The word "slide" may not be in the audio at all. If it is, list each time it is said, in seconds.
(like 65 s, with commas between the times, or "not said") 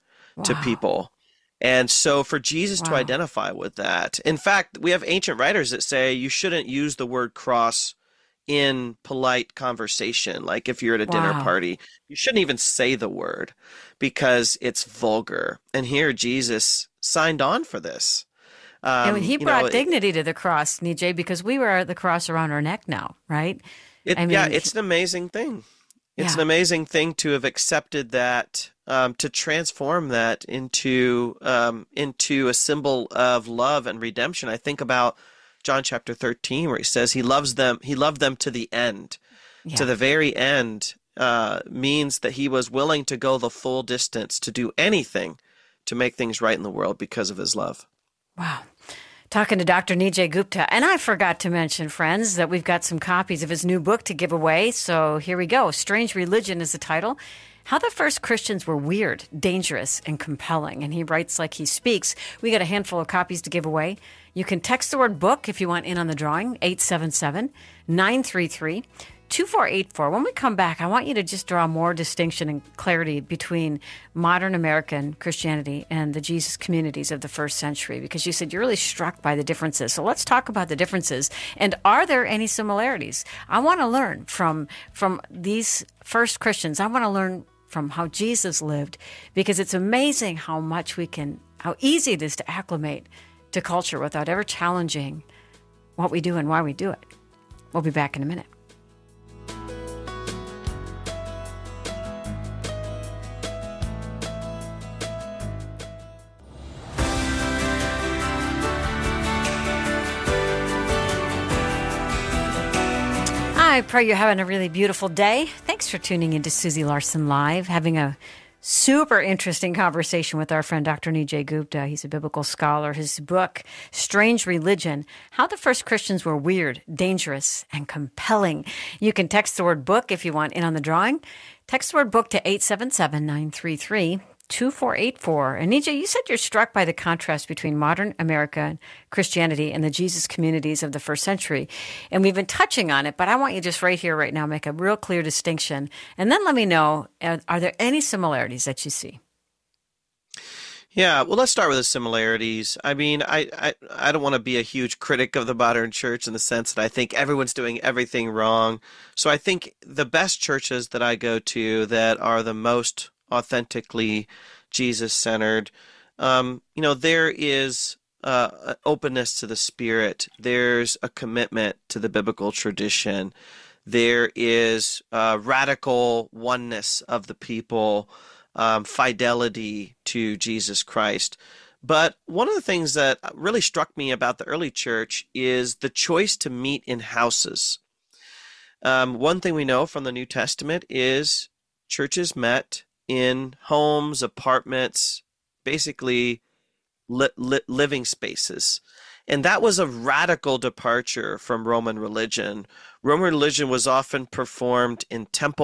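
not said.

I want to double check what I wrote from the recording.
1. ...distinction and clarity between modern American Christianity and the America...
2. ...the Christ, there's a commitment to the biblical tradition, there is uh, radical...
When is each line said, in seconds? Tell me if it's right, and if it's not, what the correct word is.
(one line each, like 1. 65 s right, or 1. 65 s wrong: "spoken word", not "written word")
1. 71 s wrong: "Jesus", not "America"
2. 169 s wrong: "Spirit", not "Christ".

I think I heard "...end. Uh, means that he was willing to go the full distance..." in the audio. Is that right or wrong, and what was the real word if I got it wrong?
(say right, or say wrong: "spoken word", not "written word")
right.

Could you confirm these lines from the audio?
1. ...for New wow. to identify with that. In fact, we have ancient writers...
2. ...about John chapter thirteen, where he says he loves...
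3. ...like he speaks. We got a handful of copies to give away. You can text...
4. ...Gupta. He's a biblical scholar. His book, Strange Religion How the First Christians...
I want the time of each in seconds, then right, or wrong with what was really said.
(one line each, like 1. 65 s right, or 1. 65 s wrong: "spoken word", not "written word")
1. 2 s wrong: "Jesus", not "New"
2. 34 s right
3. 61 s right
4. 121 s right.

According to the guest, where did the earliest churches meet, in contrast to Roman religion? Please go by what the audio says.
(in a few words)
Houses.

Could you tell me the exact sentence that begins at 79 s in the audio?
So let's talk about the differences.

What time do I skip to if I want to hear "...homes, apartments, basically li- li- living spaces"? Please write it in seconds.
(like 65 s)
193 s.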